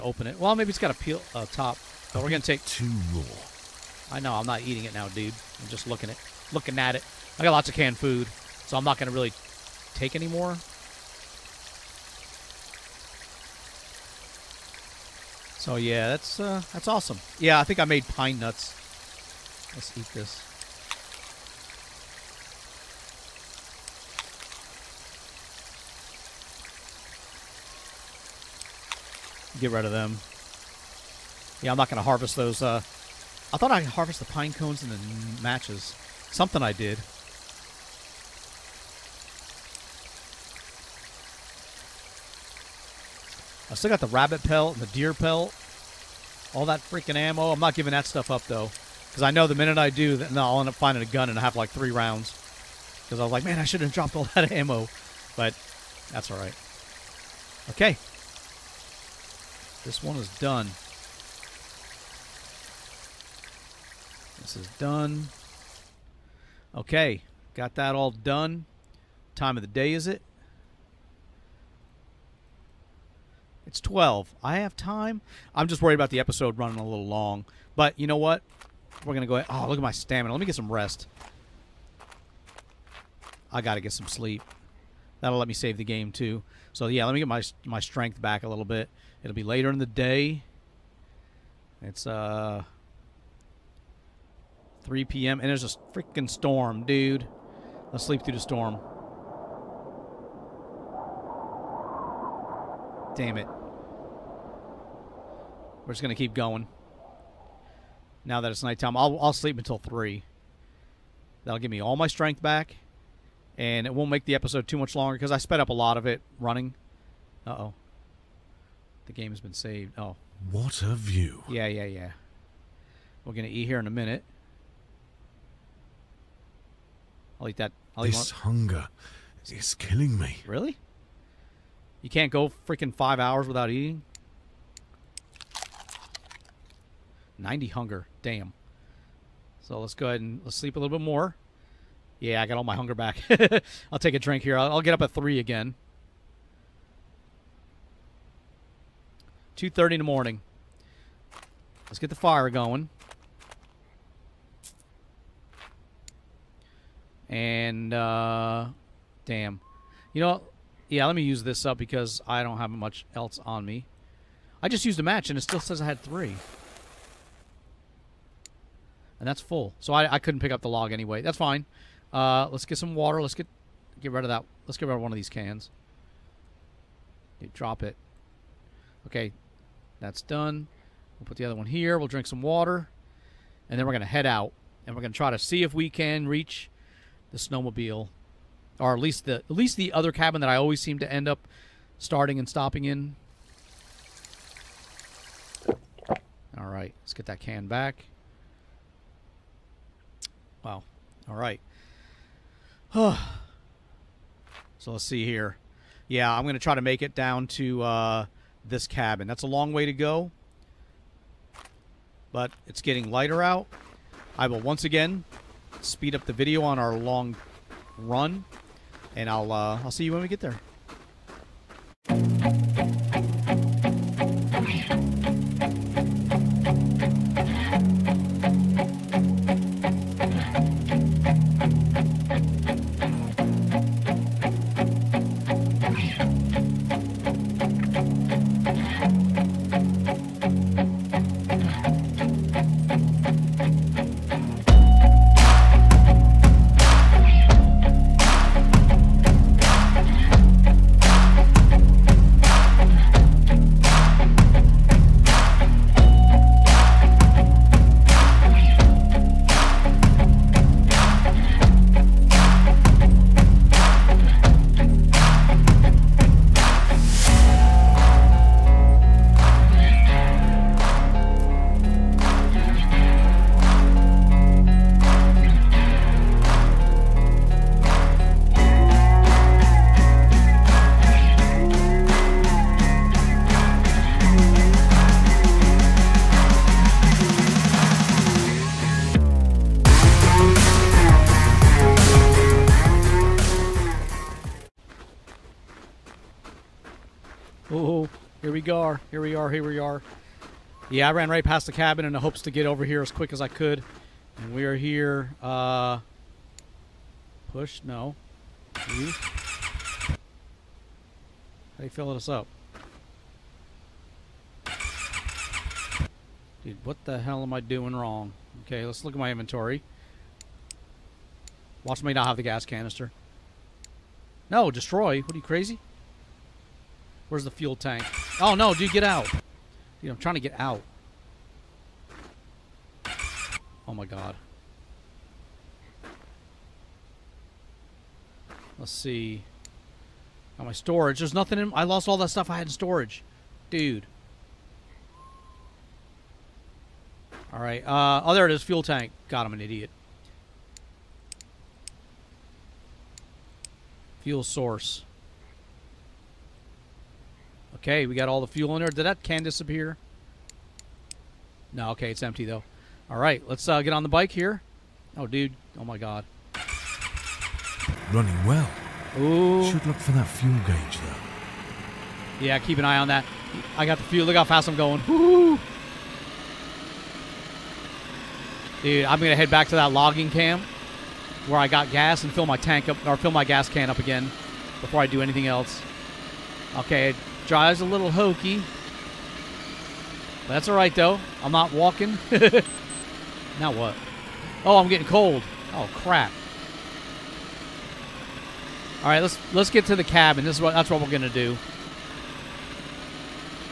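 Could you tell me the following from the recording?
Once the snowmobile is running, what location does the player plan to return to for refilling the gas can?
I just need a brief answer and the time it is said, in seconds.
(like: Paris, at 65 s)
logging camp, at 379 s.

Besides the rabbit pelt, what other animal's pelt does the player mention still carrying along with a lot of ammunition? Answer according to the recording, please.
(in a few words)
deer.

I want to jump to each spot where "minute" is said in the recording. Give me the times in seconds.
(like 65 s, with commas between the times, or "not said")
49 s, 123 s.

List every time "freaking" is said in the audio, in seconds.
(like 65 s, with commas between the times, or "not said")
46 s, 95 s, 132 s.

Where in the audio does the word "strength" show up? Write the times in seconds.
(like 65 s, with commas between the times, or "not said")
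87 s, 112 s.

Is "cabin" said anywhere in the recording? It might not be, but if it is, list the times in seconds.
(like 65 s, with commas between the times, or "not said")
190 s, 208 s, 301 s, 400 s.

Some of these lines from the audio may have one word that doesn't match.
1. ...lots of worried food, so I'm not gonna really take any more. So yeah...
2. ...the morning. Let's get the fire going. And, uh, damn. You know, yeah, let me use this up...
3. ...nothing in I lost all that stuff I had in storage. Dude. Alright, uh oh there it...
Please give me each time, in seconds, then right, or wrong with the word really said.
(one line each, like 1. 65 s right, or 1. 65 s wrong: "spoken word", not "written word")
1. 7 s wrong: "canned", not "worried"
2. 149 s right
3. 341 s right.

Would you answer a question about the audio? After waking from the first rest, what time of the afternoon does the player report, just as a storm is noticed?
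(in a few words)
3 p.m.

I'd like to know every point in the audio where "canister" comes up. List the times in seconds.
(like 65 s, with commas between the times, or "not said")
322 s.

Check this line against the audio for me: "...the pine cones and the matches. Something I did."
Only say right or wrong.
right.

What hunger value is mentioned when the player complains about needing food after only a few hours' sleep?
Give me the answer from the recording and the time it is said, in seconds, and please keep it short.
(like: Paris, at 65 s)
90, at 137 s.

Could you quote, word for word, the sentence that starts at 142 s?
Yeah, I got all my hunger back.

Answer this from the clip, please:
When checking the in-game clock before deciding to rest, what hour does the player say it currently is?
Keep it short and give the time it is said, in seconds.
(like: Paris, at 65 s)
12, at 73 s.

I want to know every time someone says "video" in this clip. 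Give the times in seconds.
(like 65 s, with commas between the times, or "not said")
216 s.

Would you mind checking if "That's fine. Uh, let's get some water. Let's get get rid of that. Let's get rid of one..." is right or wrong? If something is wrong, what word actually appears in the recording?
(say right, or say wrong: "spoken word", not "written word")
right.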